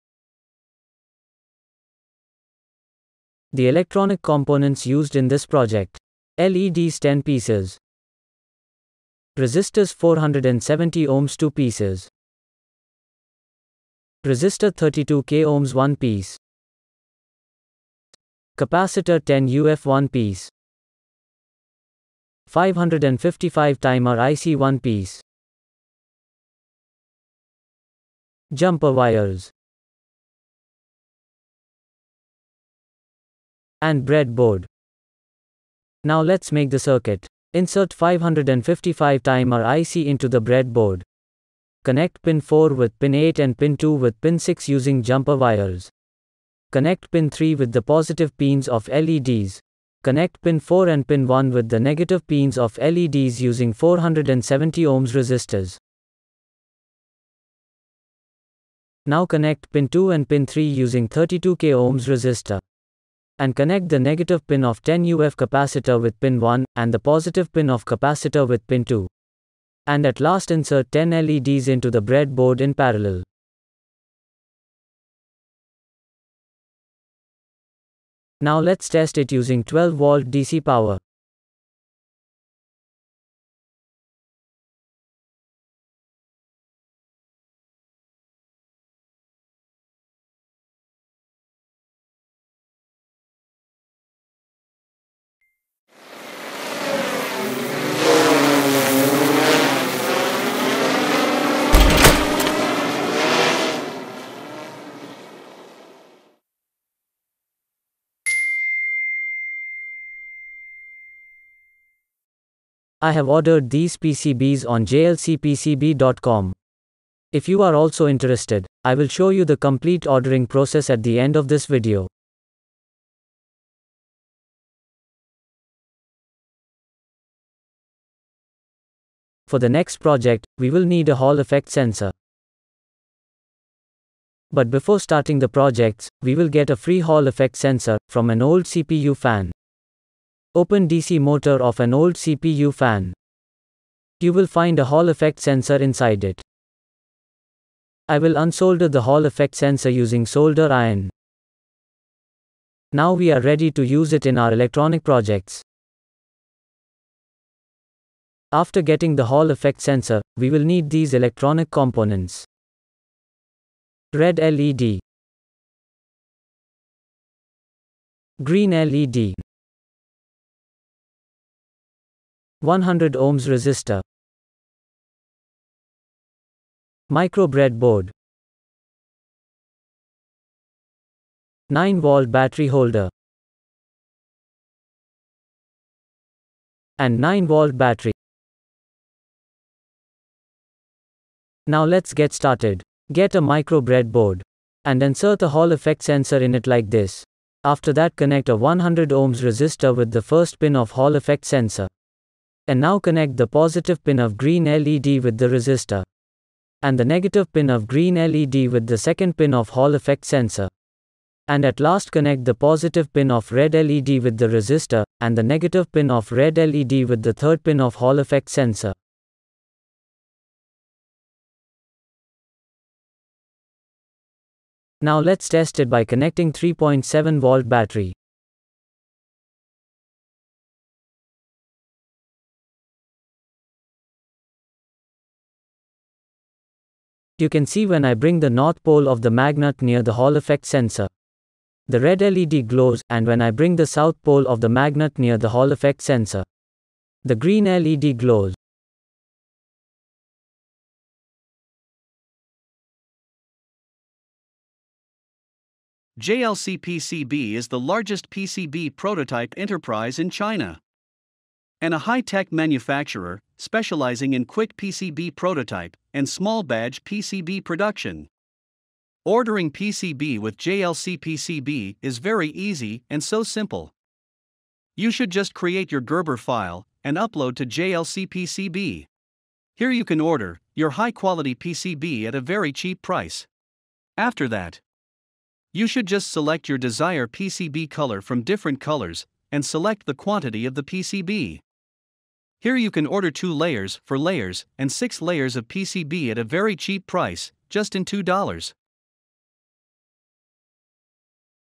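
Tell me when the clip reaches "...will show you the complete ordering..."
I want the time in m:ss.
1:58.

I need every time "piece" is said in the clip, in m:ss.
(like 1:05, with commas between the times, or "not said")
0:07, 0:11, 0:15, 0:20, 0:24.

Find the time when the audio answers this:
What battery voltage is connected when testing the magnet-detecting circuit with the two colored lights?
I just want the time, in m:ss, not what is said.
3:46.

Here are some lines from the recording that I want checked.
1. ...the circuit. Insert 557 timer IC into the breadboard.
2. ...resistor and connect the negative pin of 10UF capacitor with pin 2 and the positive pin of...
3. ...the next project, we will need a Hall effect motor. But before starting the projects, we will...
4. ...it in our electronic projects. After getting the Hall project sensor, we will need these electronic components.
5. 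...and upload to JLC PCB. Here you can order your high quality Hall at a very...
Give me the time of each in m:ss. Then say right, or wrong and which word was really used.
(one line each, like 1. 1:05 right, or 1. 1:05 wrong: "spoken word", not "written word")
1. 0:36 wrong: "555", not "557"
2. 1:02 wrong: "1", not "2"
3. 2:09 wrong: "sensor", not "motor"
4. 2:34 wrong: "effect", not "project"
5. 4:37 wrong: "PCB", not "Hall".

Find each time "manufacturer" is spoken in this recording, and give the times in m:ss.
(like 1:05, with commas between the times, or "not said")
4:22.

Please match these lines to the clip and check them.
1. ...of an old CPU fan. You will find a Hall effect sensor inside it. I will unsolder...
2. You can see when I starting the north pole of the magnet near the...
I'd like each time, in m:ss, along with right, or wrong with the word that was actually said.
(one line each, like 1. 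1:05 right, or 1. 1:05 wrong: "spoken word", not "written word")
1. 2:21 right
2. 3:57 wrong: "bring", not "starting".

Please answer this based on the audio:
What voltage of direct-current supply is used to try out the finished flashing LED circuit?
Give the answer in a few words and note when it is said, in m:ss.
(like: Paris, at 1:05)
12 volts, at 1:19.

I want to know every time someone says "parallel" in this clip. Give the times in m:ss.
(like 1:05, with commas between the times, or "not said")
1:12.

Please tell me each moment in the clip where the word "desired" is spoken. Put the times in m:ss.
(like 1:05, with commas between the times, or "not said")
4:46.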